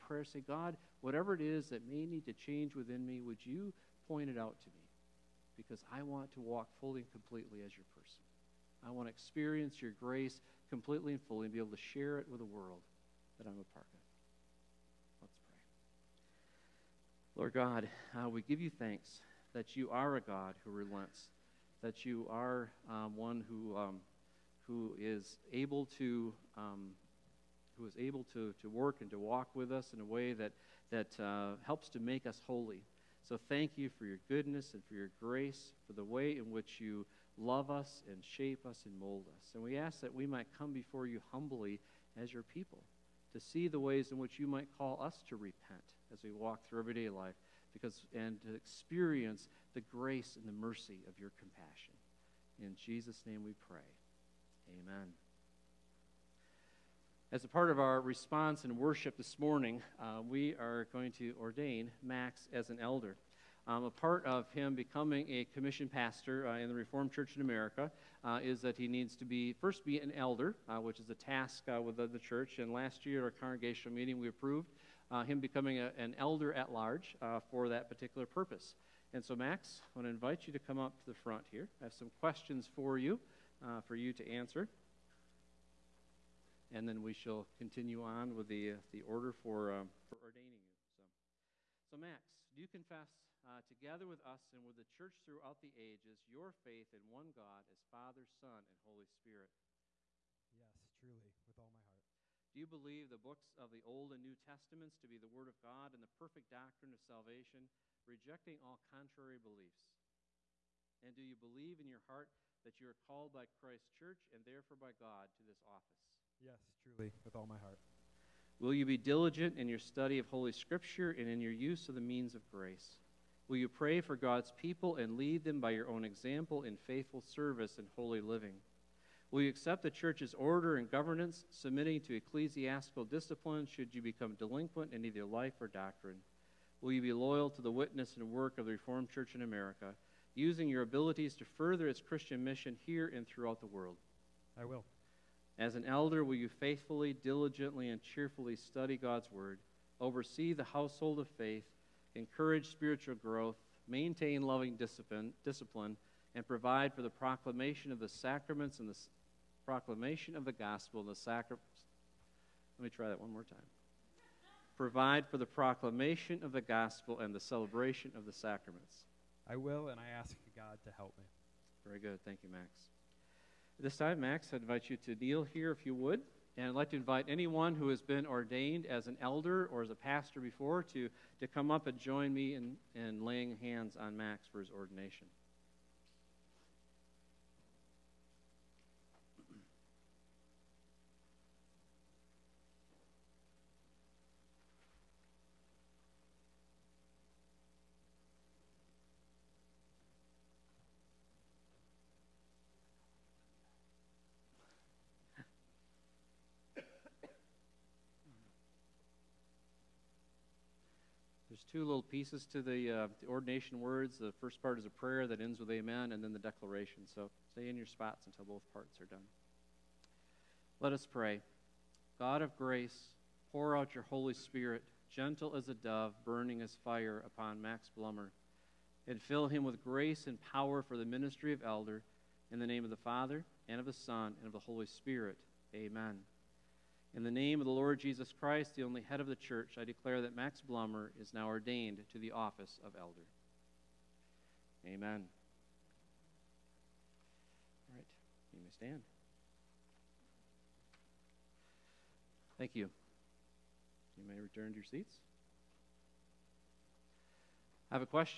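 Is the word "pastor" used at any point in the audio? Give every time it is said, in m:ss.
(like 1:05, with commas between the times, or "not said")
1:05, 2:59.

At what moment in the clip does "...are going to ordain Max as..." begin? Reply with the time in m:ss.
1:00.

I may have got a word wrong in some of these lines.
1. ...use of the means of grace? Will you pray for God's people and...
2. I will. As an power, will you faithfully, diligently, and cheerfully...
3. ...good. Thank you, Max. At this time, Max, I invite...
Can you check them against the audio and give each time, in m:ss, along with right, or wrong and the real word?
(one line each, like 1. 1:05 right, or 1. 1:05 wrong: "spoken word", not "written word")
1. 2:01 right
2. 2:24 wrong: "elder", not "power"
3. 2:51 right.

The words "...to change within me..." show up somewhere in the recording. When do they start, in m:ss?
0:02.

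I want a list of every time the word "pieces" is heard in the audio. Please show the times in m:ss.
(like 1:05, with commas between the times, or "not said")
3:32.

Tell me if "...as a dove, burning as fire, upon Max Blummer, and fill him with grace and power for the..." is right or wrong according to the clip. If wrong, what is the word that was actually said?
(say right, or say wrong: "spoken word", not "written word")
right.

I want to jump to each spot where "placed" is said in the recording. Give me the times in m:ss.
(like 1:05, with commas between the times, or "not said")
not said.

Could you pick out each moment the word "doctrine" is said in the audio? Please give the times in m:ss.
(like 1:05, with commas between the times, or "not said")
1:46, 2:15.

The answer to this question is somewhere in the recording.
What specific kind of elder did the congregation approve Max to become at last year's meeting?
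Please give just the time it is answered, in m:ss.
1:16.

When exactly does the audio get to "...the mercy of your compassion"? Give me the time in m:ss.
0:50.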